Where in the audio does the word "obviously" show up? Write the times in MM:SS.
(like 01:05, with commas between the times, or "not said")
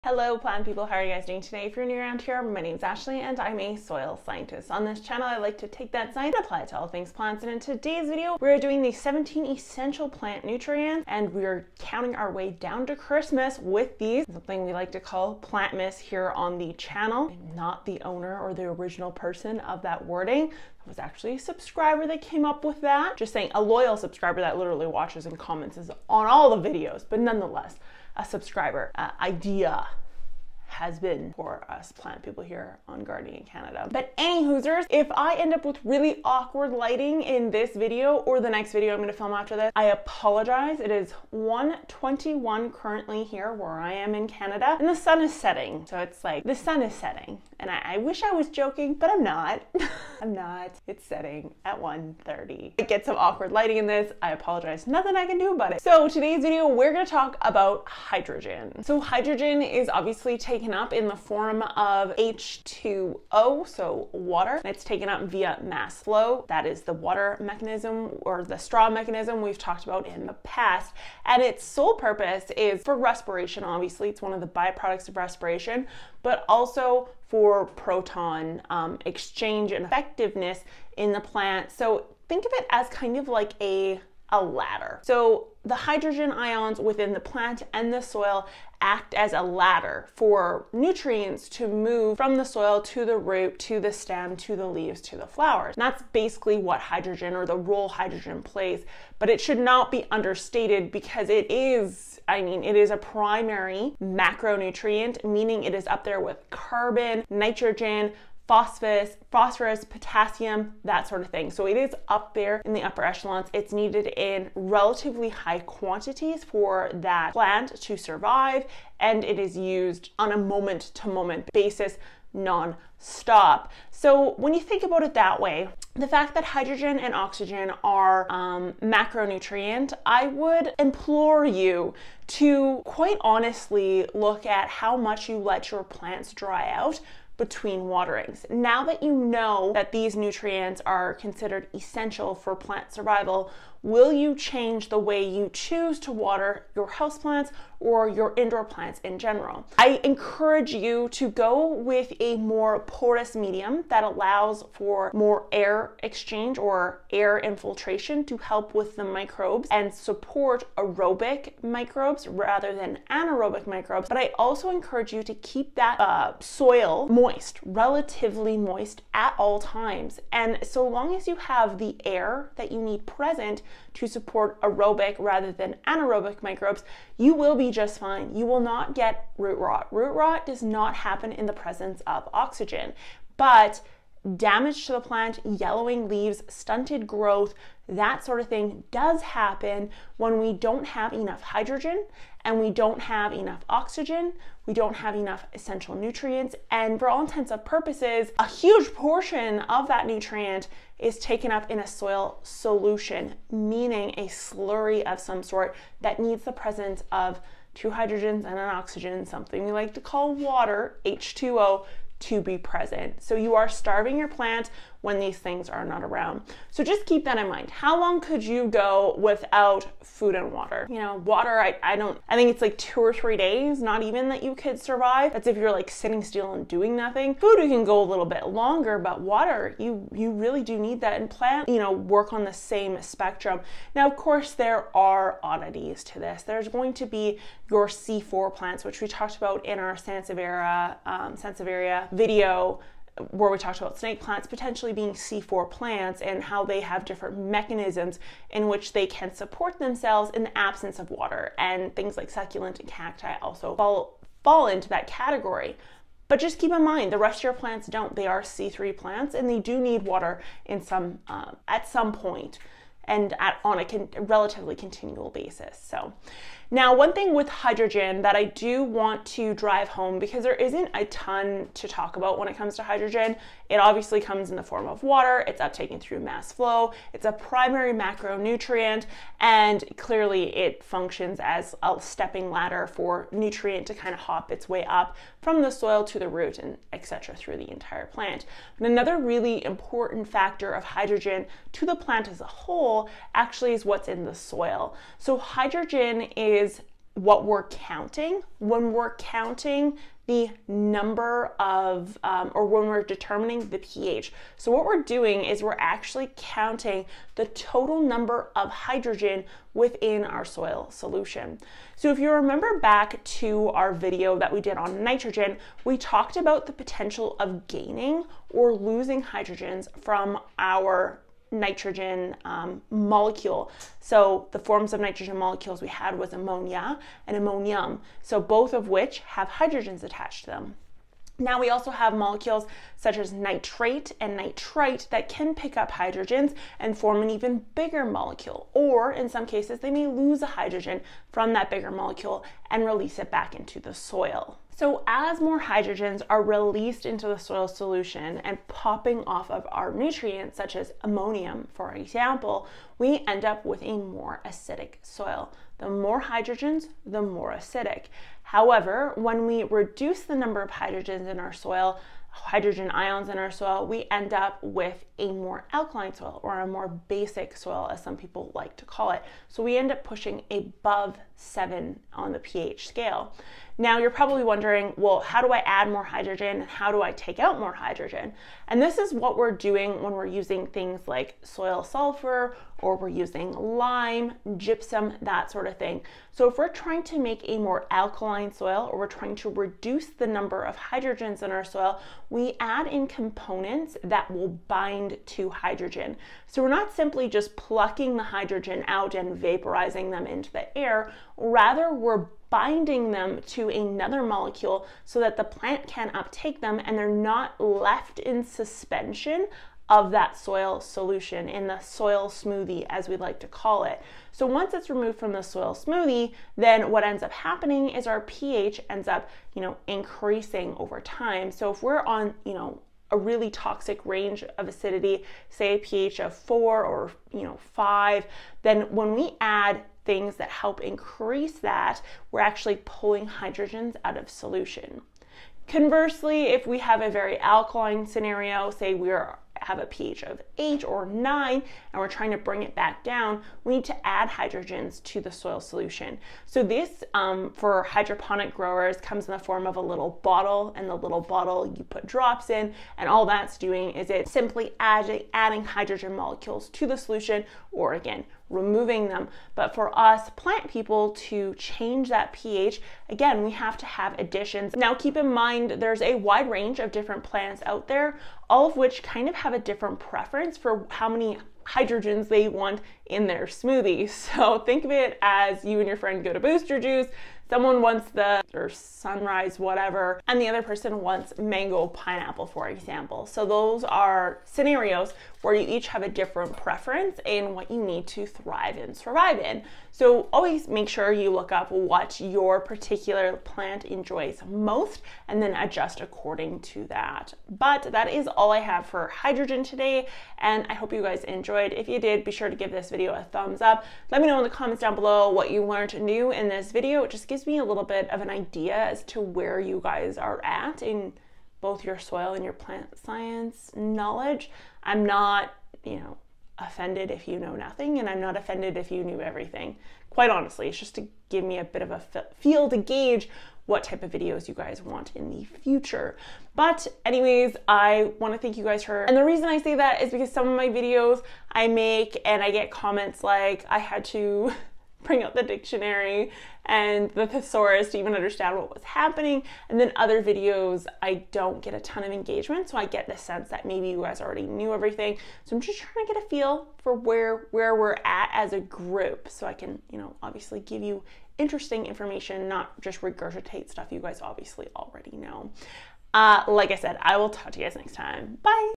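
00:59, 01:13, 04:33, 09:10, 09:14.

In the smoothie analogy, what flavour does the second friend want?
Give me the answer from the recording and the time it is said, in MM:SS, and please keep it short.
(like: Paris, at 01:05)
mango pineapple, at 08:01.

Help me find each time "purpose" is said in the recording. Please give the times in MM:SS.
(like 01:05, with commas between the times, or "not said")
01:11, 03:17.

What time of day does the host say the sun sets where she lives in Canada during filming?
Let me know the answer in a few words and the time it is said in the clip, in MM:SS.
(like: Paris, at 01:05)
1:30, at 00:51.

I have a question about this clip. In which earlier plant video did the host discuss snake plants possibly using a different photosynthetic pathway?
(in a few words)
Sansevieria video.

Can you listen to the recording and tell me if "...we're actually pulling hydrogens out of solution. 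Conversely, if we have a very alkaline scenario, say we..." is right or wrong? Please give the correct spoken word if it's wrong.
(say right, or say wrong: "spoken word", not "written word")
right.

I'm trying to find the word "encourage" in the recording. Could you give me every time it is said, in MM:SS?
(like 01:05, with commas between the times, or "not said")
02:30, 02:44.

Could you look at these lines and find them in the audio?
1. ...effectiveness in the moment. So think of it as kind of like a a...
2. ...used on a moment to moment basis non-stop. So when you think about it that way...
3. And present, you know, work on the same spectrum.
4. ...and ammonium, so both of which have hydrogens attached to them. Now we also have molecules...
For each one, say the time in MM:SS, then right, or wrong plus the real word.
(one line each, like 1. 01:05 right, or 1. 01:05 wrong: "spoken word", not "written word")
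1. 01:19 wrong: "plant", not "moment"
2. 01:59 right
3. 03:51 wrong: "plant", not "present"
4. 05:27 right.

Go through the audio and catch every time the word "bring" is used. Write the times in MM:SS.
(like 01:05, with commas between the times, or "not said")
07:22, 08:55.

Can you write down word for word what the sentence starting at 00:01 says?
If you're new around here, my name is Ashley and I'm a soil scientist.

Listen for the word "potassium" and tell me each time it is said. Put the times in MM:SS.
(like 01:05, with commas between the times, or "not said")
01:49.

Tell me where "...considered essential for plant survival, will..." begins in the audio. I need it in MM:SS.
02:21.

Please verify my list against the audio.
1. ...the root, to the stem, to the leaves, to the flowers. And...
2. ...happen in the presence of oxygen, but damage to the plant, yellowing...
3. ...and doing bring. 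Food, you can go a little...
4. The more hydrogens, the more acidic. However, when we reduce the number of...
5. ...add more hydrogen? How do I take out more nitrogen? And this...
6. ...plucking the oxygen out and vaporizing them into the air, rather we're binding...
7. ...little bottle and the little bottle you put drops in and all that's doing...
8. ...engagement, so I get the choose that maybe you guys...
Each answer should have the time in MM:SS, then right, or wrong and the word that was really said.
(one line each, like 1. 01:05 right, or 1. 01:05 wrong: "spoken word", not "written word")
1. 01:33 right
2. 03:00 right
3. 03:46 wrong: "nothing", not "bring"
4. 05:55 right
5. 06:15 wrong: "hydrogen", not "nitrogen"
6. 06:37 wrong: "hydrogen", not "oxygen"
7. 07:29 right
8. 09:02 wrong: "sense", not "choose".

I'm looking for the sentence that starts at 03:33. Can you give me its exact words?
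So you are starving your plant when these things are not around.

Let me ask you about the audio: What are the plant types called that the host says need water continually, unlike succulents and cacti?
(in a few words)
C3 plants.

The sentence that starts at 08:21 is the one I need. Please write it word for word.
If you did, be sure to give this video a thumbs up.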